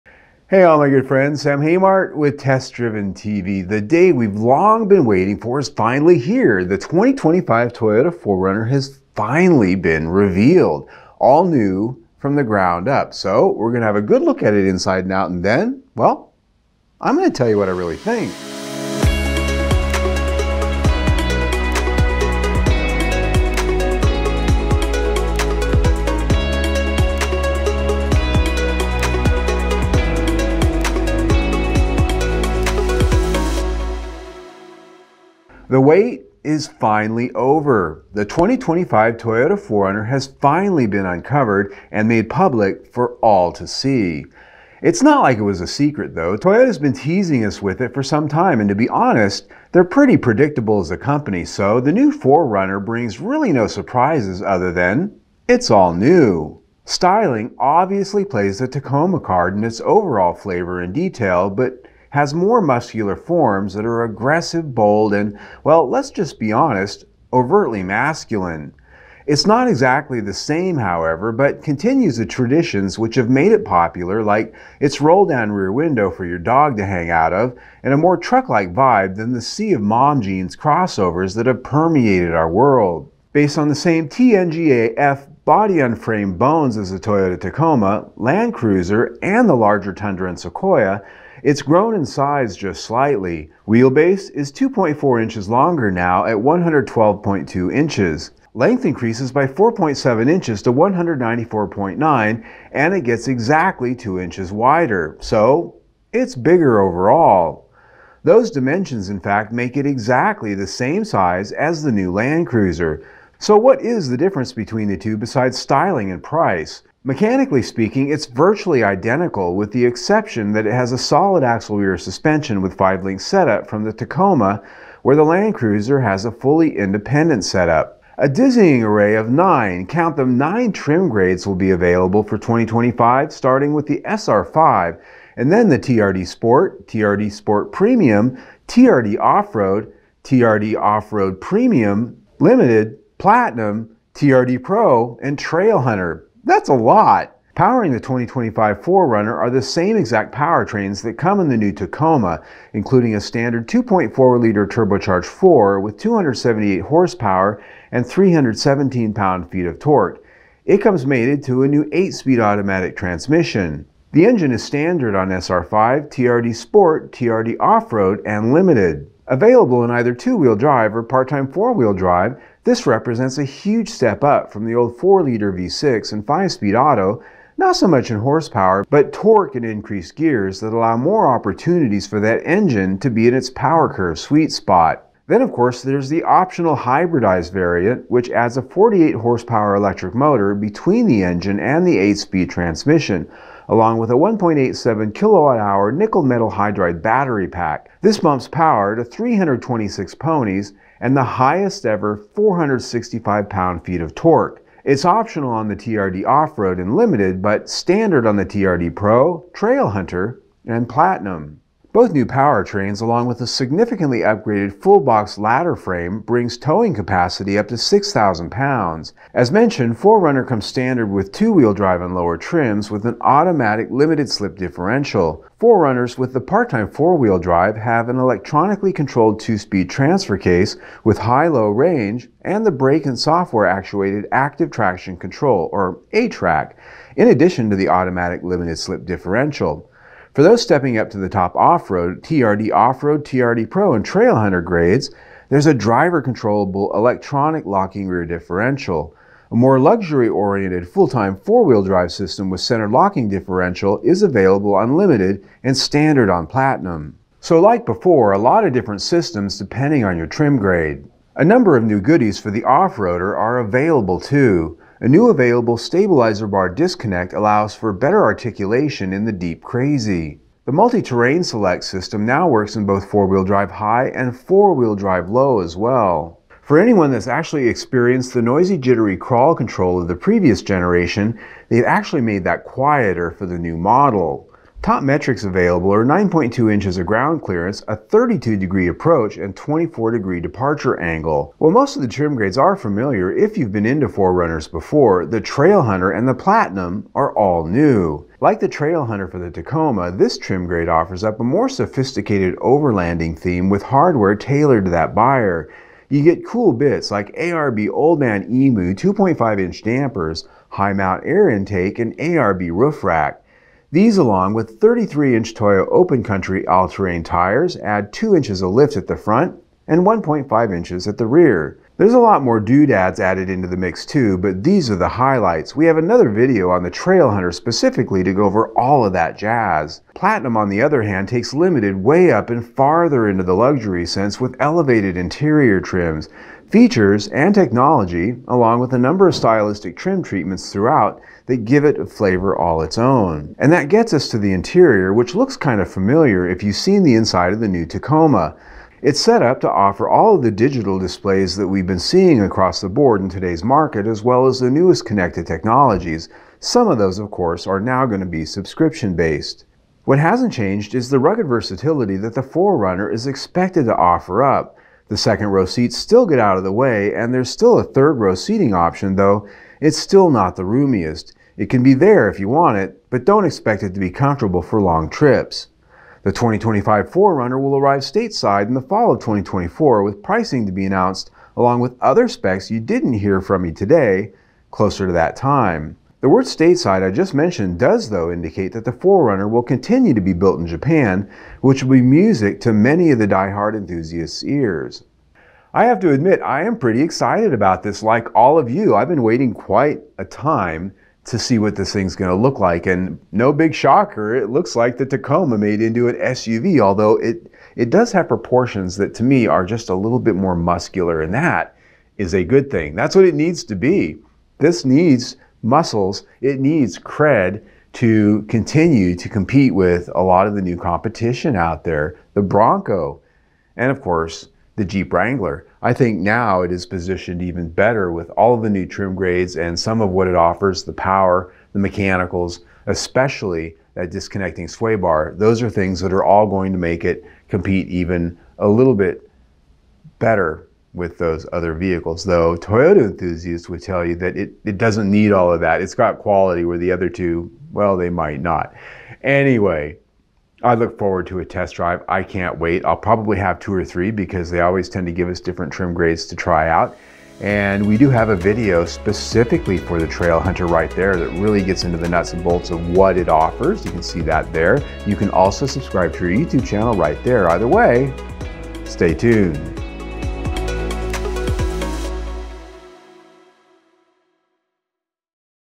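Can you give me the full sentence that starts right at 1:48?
Those dimensions in fact make it exactly the same size as the new Land Cruiser.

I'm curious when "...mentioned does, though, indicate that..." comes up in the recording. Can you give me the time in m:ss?
6:27.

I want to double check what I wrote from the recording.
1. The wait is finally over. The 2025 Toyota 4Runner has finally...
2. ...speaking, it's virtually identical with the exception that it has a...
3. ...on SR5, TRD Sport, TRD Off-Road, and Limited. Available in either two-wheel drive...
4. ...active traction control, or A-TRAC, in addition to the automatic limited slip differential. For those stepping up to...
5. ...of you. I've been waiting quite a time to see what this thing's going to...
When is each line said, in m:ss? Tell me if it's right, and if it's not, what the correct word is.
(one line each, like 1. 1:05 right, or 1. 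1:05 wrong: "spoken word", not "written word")
1. 0:35 right
2. 1:57 right
3. 2:45 right
4. 3:54 right
5. 6:38 right.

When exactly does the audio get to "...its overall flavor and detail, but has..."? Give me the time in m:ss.
0:59.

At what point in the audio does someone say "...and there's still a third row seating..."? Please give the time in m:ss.
6:07.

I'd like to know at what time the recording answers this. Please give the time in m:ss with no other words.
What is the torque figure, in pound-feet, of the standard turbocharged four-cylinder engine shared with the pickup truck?
2:38.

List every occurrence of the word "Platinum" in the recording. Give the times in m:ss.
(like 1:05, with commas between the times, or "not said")
2:23, 3:30, 4:16, 4:56, 5:30.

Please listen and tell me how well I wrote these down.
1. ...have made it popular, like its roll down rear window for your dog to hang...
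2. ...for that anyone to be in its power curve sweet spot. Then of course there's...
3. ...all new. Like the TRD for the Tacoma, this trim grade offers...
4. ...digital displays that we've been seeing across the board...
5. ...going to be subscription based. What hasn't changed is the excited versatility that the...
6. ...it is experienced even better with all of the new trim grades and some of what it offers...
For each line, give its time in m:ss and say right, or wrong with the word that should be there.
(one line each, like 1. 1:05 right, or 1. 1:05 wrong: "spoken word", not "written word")
1. 1:13 right
2. 3:02 wrong: "engine", not "anyone"
3. 4:57 wrong: "Trailhunter", not "TRD"
4. 5:50 right
5. 5:58 wrong: "rugged", not "excited"
6. 7:06 wrong: "positioned", not "experienced".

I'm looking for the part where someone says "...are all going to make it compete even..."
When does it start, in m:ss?
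7:16.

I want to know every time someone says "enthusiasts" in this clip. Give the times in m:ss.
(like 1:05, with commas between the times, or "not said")
6:33, 7:23.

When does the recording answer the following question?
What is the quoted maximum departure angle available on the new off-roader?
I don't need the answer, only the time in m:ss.
4:49.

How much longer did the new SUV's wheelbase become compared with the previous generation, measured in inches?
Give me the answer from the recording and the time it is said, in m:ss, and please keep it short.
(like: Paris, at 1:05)
2.4 inches, at 1:34.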